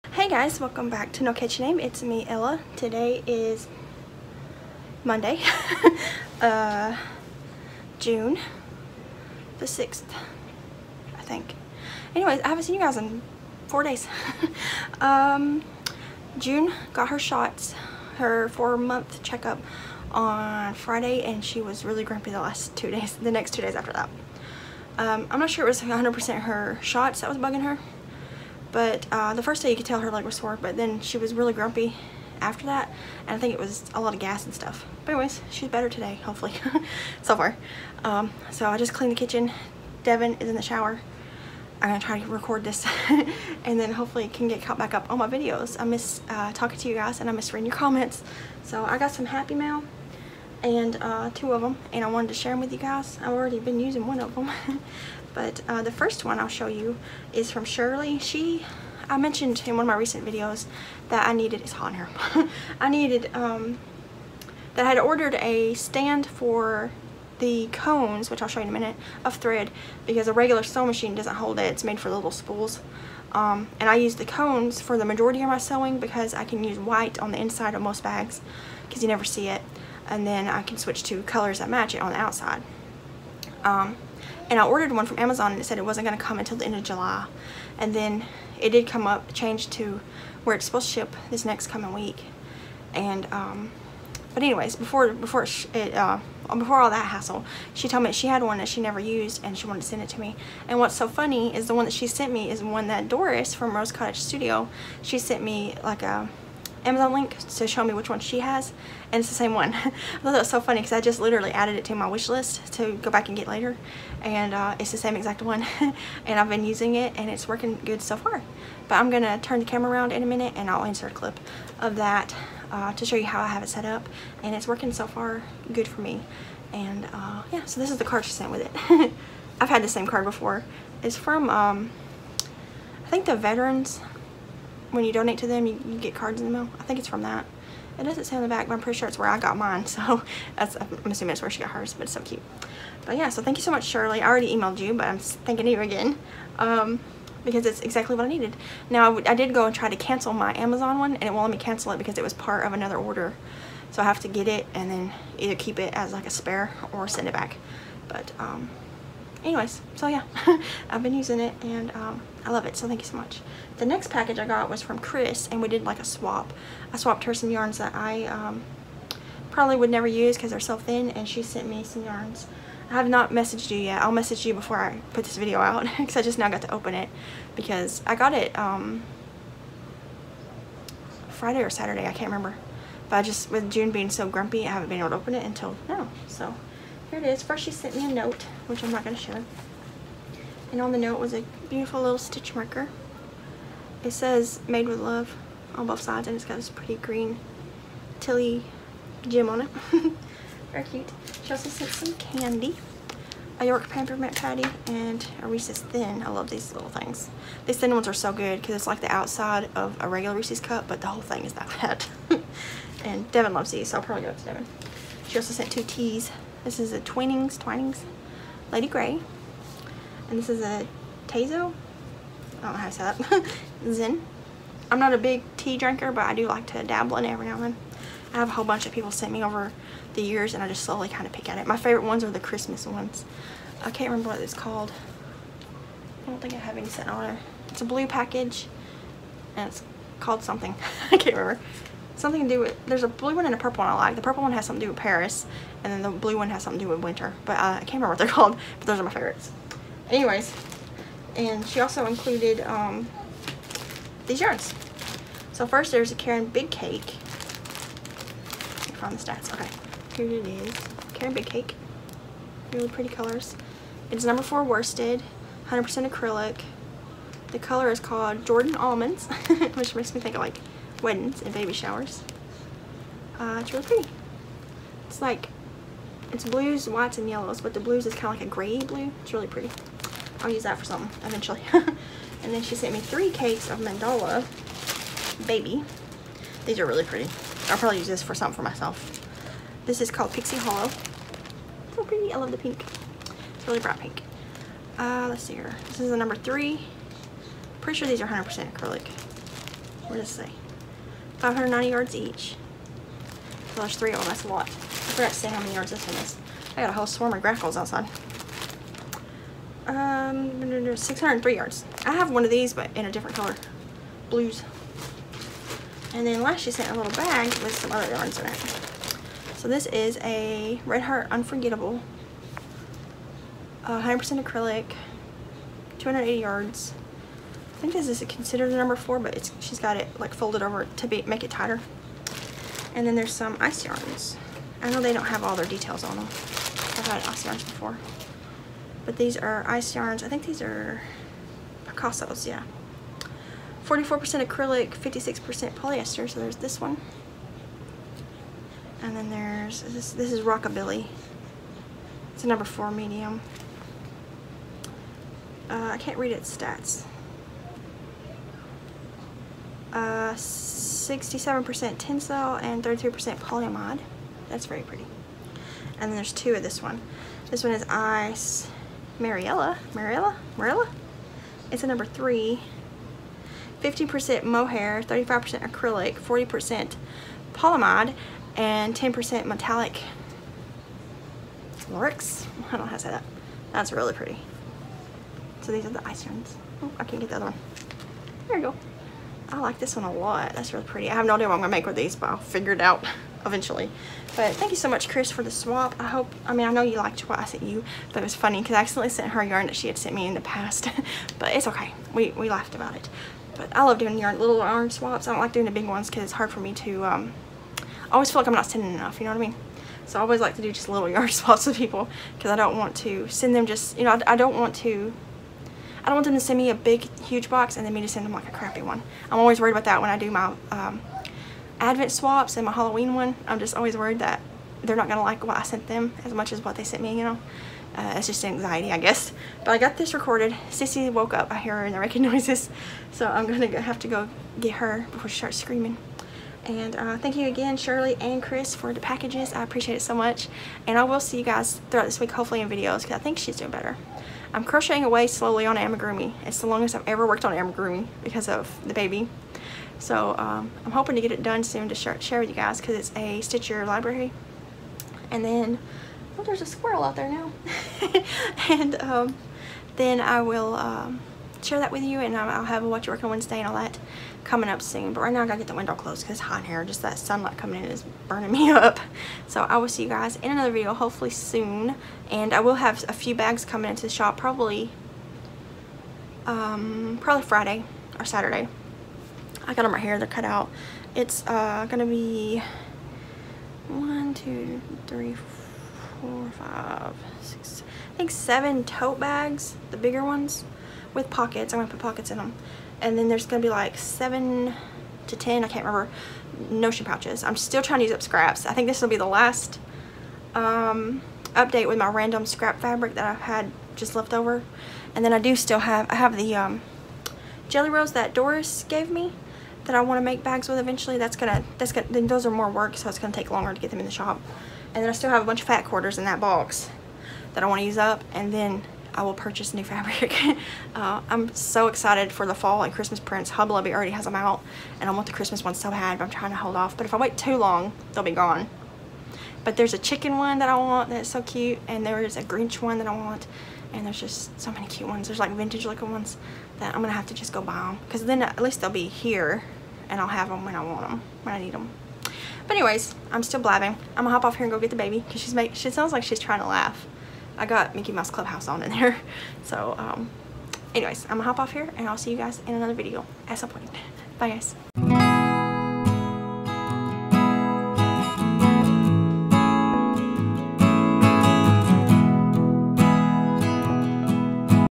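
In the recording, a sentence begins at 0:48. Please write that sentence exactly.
So I got some Happy Mail and uh, two of them and I wanted to share them with you guys.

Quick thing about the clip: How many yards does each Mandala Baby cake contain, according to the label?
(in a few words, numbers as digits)
590 yards.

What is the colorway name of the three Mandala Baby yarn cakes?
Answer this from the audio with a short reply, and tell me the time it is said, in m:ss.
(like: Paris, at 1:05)
Pixie Hollow, at 4:50.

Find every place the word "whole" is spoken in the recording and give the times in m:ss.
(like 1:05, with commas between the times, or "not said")
3:31, 3:48, 5:06.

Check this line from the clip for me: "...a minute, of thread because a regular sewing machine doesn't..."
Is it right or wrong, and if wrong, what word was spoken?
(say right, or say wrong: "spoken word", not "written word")
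right.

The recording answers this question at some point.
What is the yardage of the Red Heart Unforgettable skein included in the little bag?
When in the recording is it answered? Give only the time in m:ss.
5:25.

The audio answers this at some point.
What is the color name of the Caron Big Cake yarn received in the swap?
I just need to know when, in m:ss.
4:28.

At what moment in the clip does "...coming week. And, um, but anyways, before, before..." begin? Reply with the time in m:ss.
1:31.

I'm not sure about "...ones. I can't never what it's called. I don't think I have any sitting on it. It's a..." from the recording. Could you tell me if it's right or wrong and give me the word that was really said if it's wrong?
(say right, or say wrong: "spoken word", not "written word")
wrong: "remember", not "never".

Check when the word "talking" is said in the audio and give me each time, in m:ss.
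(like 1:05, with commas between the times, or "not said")
0:46.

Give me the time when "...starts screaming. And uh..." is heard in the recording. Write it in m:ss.
7:15.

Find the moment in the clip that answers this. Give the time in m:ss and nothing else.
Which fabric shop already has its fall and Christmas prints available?
8:43.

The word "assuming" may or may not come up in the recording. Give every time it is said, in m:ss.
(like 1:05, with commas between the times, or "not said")
2:21.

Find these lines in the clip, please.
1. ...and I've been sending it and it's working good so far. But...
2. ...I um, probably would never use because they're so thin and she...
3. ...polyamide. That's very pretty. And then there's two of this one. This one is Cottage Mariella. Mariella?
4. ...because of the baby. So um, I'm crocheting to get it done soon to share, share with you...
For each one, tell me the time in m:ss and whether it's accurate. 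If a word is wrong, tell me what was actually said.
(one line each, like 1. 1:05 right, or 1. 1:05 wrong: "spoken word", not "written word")
1. 1:56 wrong: "using", not "sending"
2. 2:47 right
3. 6:03 wrong: "Ice", not "Cottage"
4. 7:28 wrong: "hoping", not "crocheting".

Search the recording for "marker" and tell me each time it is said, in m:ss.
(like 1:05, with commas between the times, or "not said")
3:12.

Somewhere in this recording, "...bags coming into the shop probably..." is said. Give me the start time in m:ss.
7:53.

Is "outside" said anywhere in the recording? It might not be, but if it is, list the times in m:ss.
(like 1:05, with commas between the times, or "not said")
1:22, 3:29, 5:07.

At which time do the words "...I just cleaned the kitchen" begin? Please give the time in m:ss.
0:38.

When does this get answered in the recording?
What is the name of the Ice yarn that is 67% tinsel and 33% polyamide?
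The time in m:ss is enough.
5:50.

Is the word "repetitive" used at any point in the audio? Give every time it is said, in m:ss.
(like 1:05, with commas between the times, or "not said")
not said.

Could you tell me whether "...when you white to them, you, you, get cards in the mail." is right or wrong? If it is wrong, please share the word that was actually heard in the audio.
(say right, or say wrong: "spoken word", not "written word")
wrong: "donate", not "white".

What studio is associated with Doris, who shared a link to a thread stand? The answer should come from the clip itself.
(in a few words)
Rose Cottage Studio.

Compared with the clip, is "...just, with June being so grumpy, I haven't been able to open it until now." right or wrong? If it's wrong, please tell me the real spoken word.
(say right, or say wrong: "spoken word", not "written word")
right.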